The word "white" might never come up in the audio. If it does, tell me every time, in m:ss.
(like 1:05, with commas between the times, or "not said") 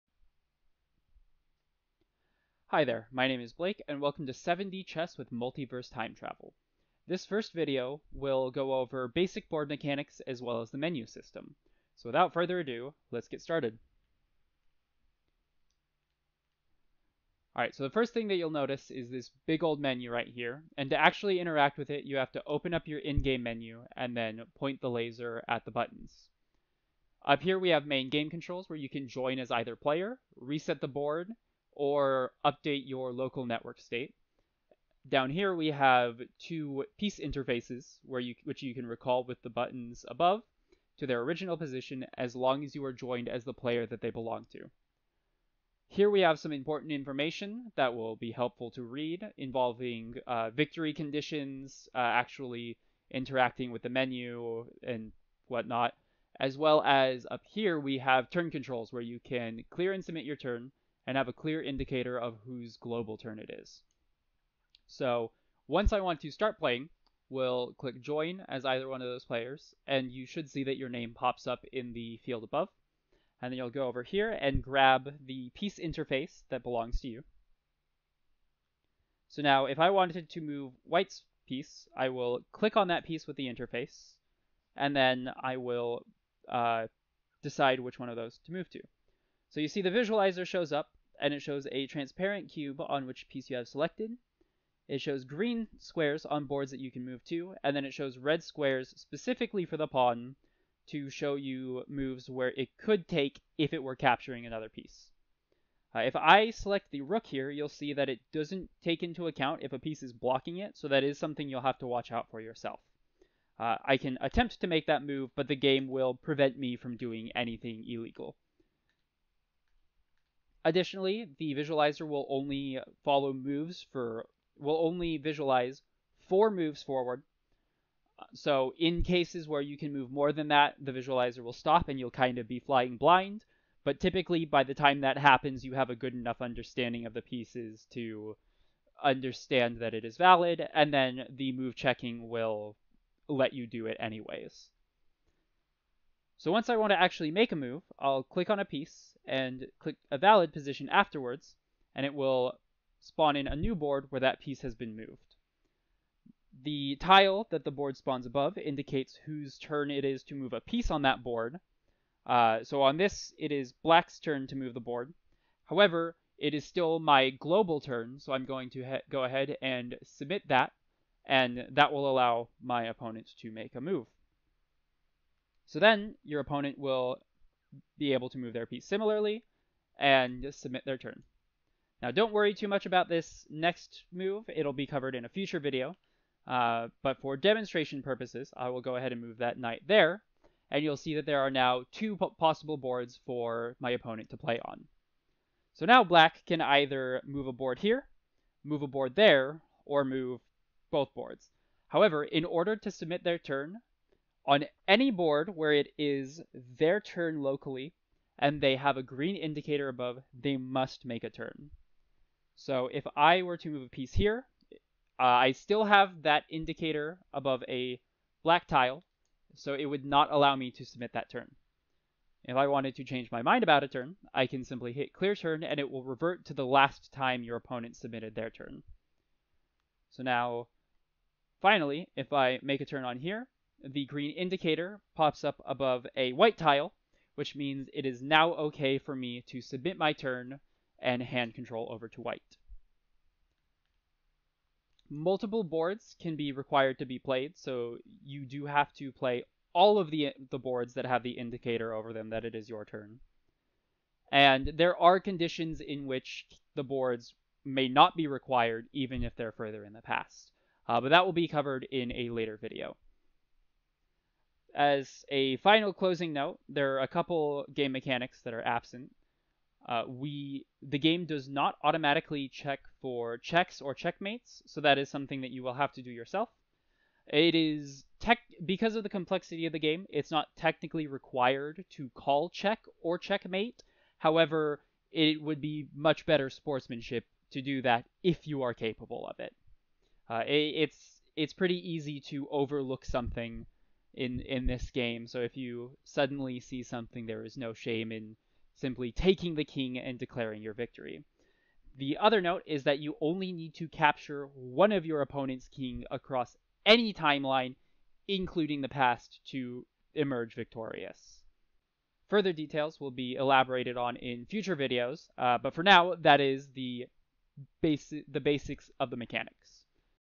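1:20, 3:56, 4:02.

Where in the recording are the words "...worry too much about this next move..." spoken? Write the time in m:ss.
3:02.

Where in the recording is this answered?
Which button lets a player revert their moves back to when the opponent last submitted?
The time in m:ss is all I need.
3:45.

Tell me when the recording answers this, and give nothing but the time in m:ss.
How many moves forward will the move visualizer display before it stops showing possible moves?
2:06.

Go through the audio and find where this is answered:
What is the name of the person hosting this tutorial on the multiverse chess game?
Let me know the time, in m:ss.
0:03.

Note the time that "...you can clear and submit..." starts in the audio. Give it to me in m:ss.
0:59.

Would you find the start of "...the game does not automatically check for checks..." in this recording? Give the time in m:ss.
4:30.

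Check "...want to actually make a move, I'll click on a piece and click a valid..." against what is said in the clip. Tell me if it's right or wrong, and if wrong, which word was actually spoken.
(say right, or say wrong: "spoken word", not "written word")
right.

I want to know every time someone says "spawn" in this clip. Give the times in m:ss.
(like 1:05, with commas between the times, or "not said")
2:32, 2:37.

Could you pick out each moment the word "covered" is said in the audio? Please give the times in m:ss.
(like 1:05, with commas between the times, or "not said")
3:04, 4:21.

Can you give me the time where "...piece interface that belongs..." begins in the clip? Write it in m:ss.
1:15.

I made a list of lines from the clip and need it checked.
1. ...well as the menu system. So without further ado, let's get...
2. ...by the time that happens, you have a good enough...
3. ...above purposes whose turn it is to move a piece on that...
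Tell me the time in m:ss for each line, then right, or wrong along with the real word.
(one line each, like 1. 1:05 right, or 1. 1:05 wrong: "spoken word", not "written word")
1. 0:10 right
2. 2:14 right
3. 2:38 wrong: "indicates", not "purposes".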